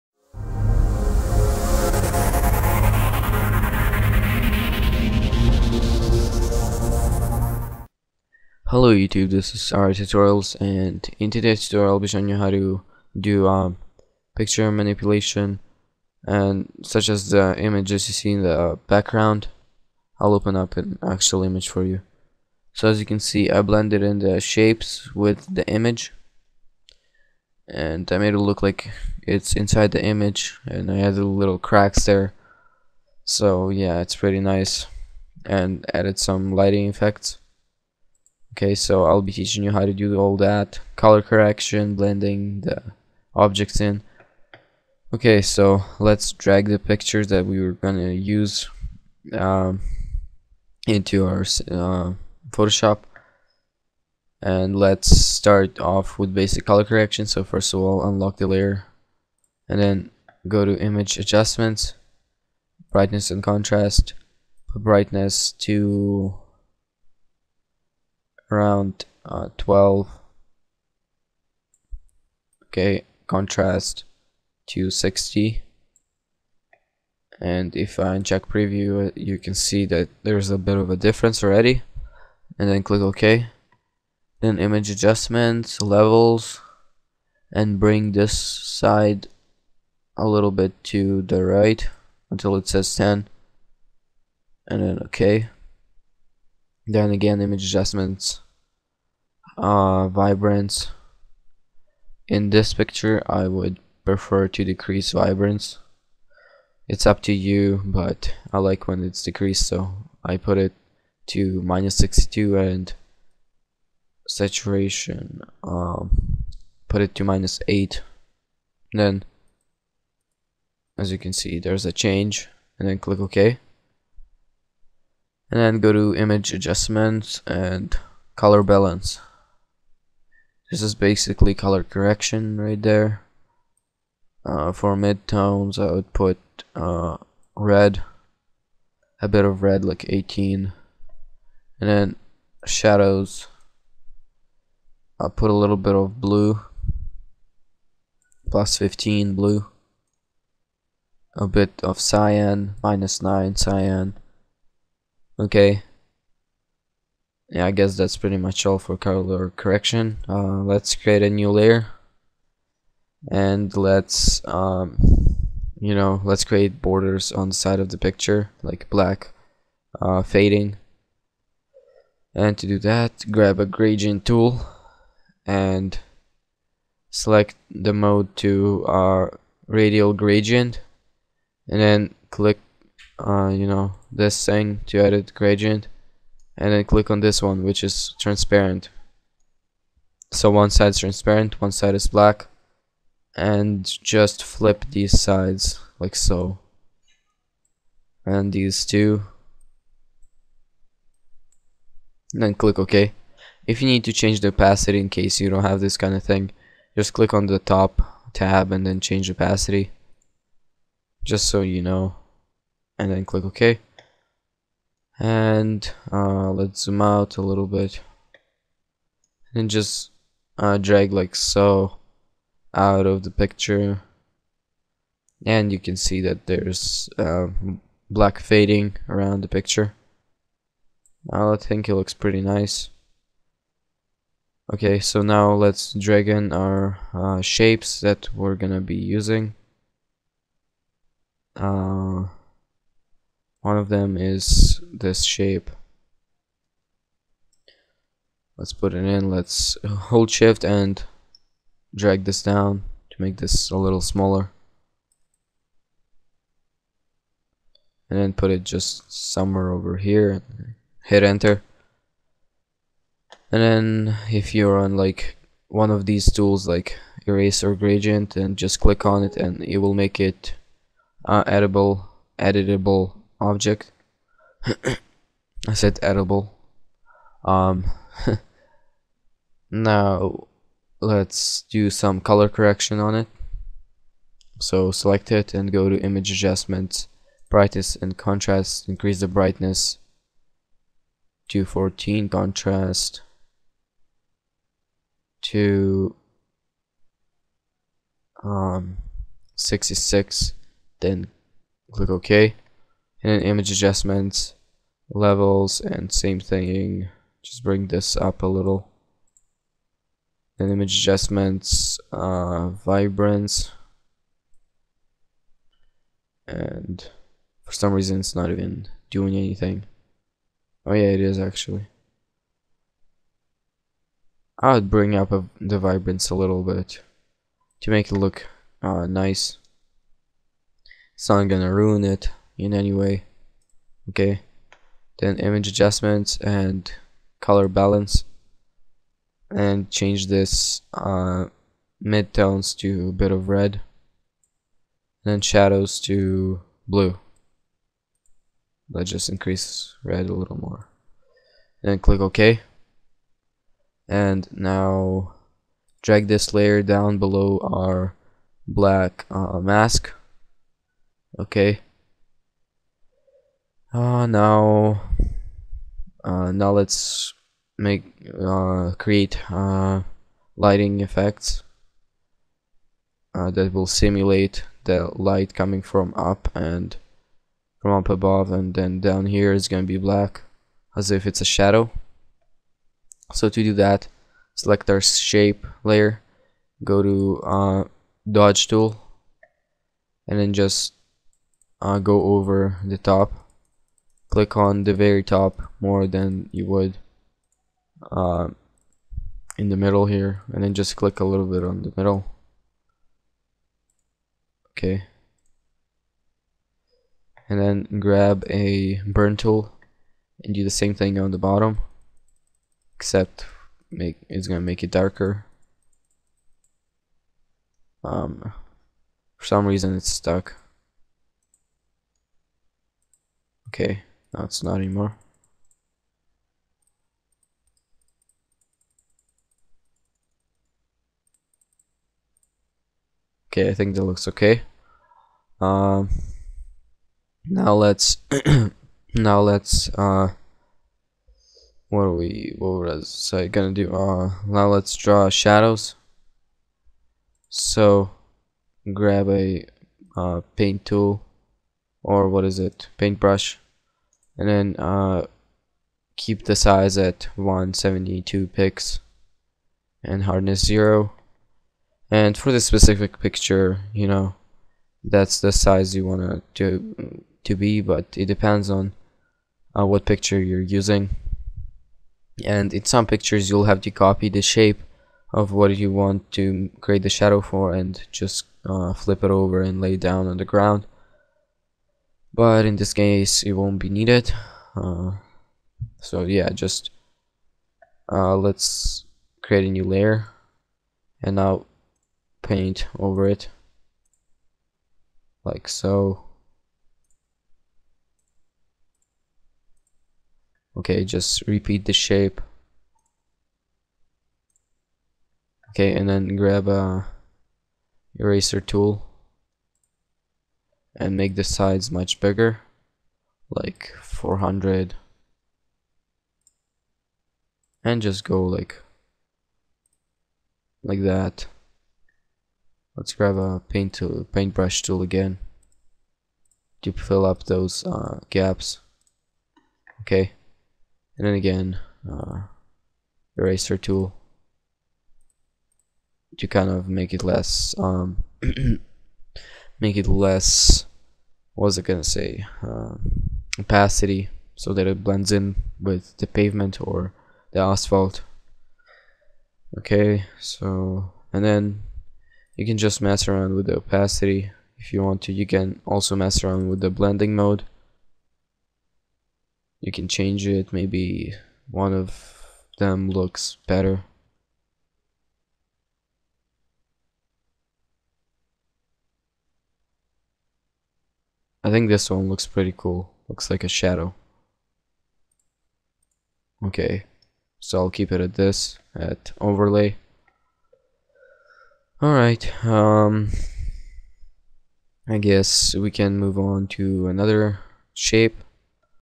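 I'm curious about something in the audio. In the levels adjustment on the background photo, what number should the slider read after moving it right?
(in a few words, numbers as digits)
10.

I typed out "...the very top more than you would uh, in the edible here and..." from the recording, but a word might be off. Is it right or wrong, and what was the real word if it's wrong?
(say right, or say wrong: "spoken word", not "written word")
wrong: "middle", not "edible".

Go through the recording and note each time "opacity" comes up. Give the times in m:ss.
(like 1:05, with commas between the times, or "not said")
3:24, 3:29, 9:03, 9:13.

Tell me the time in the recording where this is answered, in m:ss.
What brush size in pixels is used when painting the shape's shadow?
7:37.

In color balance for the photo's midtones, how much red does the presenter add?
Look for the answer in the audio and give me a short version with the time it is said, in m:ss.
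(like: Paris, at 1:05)
18, at 2:19.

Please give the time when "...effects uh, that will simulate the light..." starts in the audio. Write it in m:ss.
6:11.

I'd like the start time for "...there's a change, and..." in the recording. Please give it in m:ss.
2:01.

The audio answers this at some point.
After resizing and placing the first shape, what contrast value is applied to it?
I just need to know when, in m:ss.
4:59.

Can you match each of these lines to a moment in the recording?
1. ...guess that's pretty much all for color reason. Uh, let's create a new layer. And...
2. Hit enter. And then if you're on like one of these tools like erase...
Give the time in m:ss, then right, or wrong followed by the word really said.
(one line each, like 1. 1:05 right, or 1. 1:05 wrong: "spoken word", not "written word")
1. 2:37 wrong: "correction", not "reason"
2. 4:21 right.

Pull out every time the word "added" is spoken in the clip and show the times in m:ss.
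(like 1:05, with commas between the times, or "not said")
0:31, 0:35.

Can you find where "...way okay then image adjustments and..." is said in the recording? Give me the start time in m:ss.
5:32.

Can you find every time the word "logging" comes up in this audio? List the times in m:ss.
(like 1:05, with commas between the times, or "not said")
not said.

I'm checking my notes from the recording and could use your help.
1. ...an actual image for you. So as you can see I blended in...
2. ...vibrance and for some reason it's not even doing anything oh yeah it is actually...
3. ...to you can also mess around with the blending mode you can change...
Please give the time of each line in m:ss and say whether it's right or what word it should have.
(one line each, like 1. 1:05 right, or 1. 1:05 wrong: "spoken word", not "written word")
1. 0:20 right
2. 5:12 right
3. 9:15 right.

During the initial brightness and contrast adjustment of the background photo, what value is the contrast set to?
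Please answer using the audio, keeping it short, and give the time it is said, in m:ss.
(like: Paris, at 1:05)
60, at 1:13.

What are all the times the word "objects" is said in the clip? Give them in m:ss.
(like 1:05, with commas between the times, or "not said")
0:43, 4:33.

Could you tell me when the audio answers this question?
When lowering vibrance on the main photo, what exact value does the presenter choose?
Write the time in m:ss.
1:51.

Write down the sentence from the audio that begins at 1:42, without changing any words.
In this picture, I would prefer to decrease vibrance.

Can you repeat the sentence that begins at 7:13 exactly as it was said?
Okay, I think that looks okay.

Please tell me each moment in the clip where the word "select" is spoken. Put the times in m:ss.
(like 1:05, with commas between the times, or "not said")
2:57, 4:44, 6:24.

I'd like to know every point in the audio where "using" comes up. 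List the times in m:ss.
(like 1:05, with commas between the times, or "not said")
3:58, 7:50.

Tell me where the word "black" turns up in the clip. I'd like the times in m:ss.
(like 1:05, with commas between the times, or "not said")
2:48, 3:12, 3:48, 5:58, 6:19.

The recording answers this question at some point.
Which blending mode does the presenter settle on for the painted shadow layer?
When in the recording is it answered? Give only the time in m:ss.
9:39.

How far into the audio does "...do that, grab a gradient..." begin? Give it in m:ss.
2:52.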